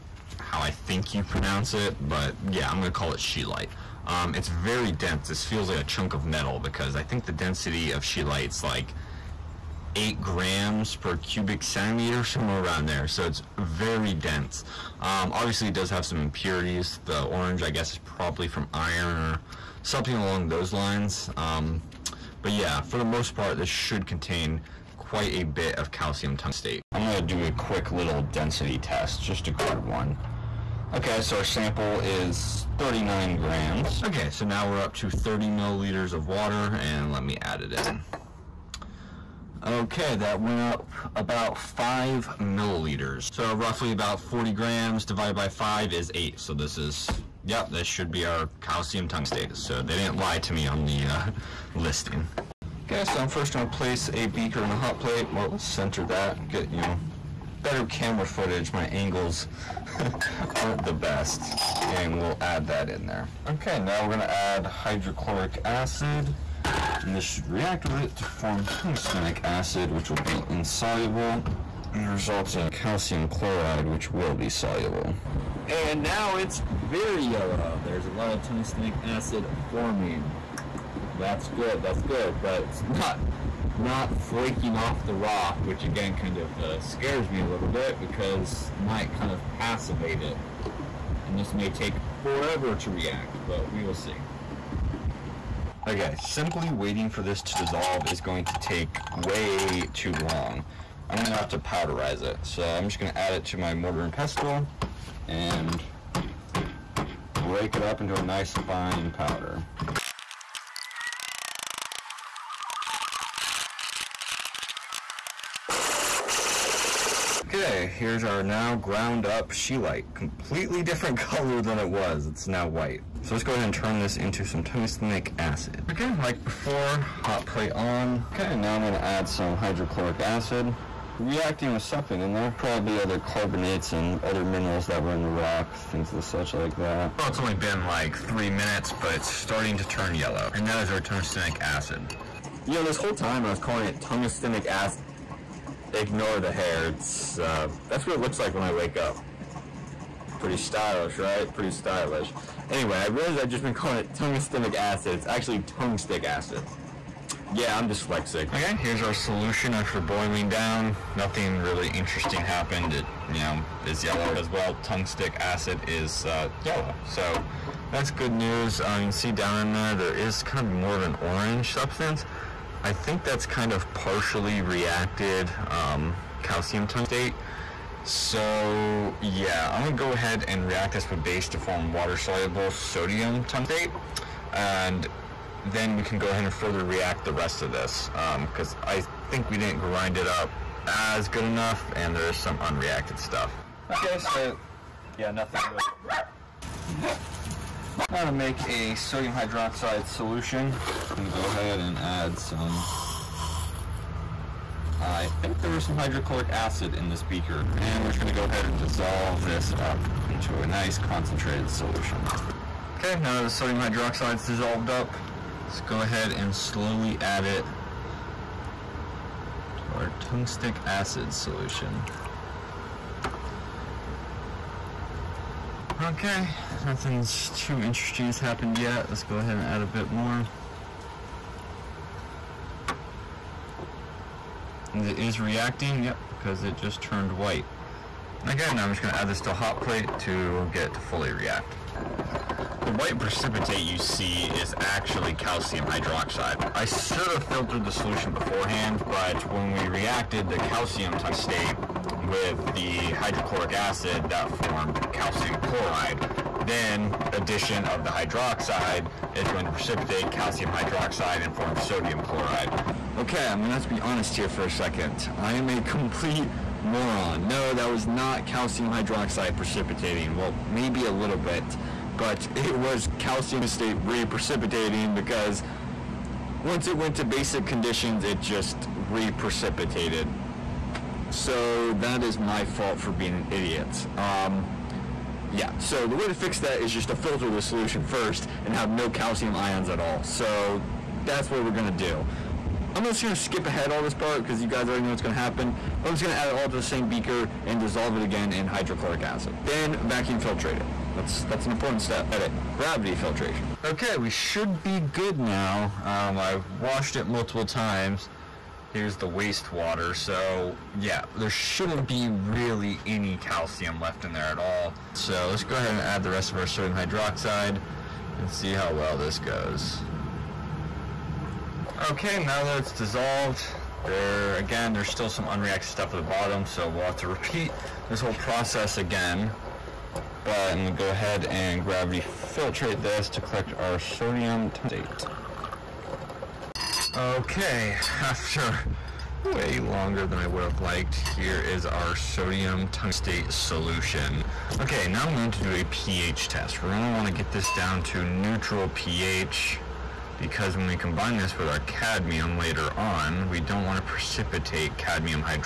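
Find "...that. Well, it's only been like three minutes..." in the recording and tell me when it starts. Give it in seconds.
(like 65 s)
136 s.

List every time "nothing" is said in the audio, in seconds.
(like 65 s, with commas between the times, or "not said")
161 s, 195 s, 226 s.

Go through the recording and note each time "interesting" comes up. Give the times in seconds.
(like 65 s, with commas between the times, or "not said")
161 s, 227 s.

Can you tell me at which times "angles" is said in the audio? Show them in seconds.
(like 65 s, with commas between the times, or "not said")
58 s.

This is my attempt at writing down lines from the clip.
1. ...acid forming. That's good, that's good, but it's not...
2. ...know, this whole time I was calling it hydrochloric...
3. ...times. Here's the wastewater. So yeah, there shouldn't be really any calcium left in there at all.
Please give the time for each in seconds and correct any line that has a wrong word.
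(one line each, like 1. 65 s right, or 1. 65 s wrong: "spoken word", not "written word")
1. 79 s right
2. 142 s wrong: "tungstenic", not "hydrochloric"
3. 307 s right.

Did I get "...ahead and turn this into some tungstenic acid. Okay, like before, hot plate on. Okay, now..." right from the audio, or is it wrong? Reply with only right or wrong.
right.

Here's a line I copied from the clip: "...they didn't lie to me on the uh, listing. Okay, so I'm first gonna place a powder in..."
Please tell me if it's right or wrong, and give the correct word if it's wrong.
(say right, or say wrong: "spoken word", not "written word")
wrong: "beaker", not "powder".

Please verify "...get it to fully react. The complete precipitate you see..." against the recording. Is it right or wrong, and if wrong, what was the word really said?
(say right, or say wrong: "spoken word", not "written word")
wrong: "white", not "complete".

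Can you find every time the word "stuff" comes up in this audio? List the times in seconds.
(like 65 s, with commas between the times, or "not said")
193 s, 325 s.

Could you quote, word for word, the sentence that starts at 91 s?
And this may take forever to react, but we will see.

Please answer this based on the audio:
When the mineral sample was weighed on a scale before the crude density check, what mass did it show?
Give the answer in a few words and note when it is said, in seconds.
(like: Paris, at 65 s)
39 grams, at 32 s.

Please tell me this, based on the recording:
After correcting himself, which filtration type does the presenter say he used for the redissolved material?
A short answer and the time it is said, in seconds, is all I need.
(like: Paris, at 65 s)
Gravity filtration, at 302 s.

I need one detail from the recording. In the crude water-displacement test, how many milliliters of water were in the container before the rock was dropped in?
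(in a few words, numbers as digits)
30 milliliters.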